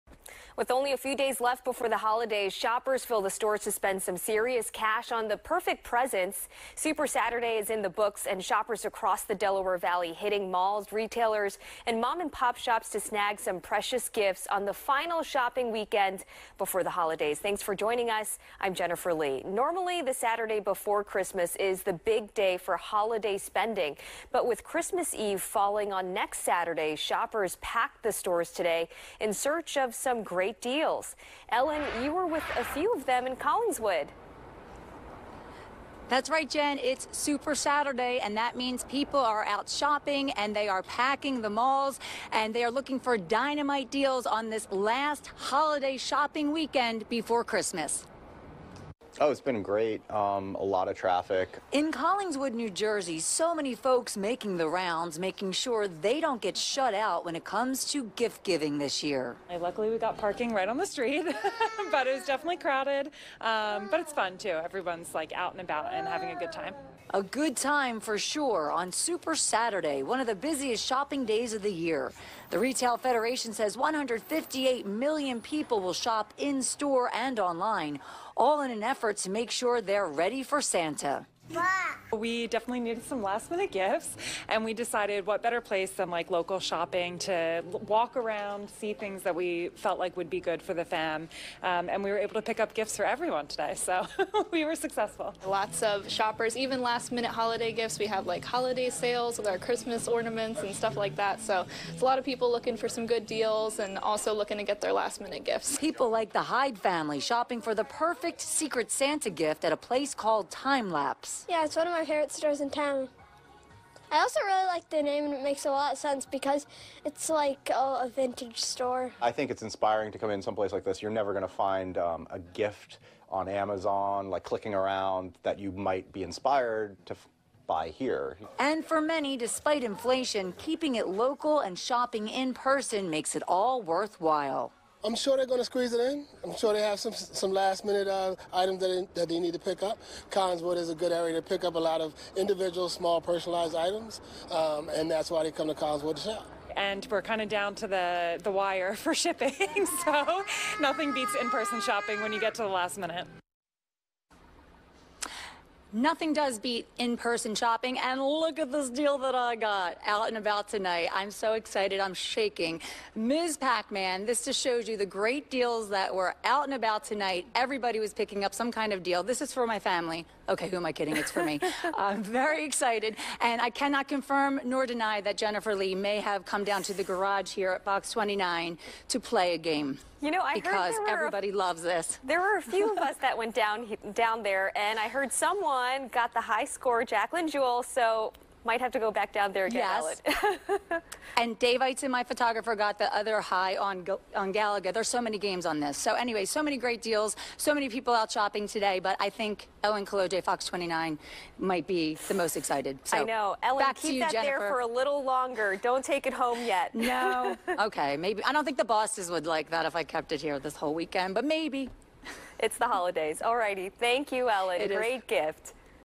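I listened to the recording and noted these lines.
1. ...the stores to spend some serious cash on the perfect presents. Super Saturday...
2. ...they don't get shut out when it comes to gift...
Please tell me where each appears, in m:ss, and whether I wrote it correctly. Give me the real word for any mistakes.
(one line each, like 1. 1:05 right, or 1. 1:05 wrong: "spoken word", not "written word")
1. 0:03 right
2. 0:55 right.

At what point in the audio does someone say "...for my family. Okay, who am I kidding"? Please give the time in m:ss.
2:49.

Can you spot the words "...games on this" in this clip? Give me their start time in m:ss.
3:15.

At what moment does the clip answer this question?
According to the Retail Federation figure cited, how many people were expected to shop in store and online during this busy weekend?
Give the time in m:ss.
1:13.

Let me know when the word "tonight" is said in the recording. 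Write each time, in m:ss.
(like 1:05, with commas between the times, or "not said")
2:40, 2:47.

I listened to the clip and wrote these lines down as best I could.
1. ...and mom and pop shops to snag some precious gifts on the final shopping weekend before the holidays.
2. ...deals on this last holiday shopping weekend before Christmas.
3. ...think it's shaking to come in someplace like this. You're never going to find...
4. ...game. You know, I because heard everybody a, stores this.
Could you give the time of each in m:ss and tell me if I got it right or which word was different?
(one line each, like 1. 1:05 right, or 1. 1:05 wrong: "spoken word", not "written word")
1. 0:11 right
2. 0:43 right
3. 1:59 wrong: "inspiring", not "shaking"
4. 2:59 wrong: "loves", not "stores".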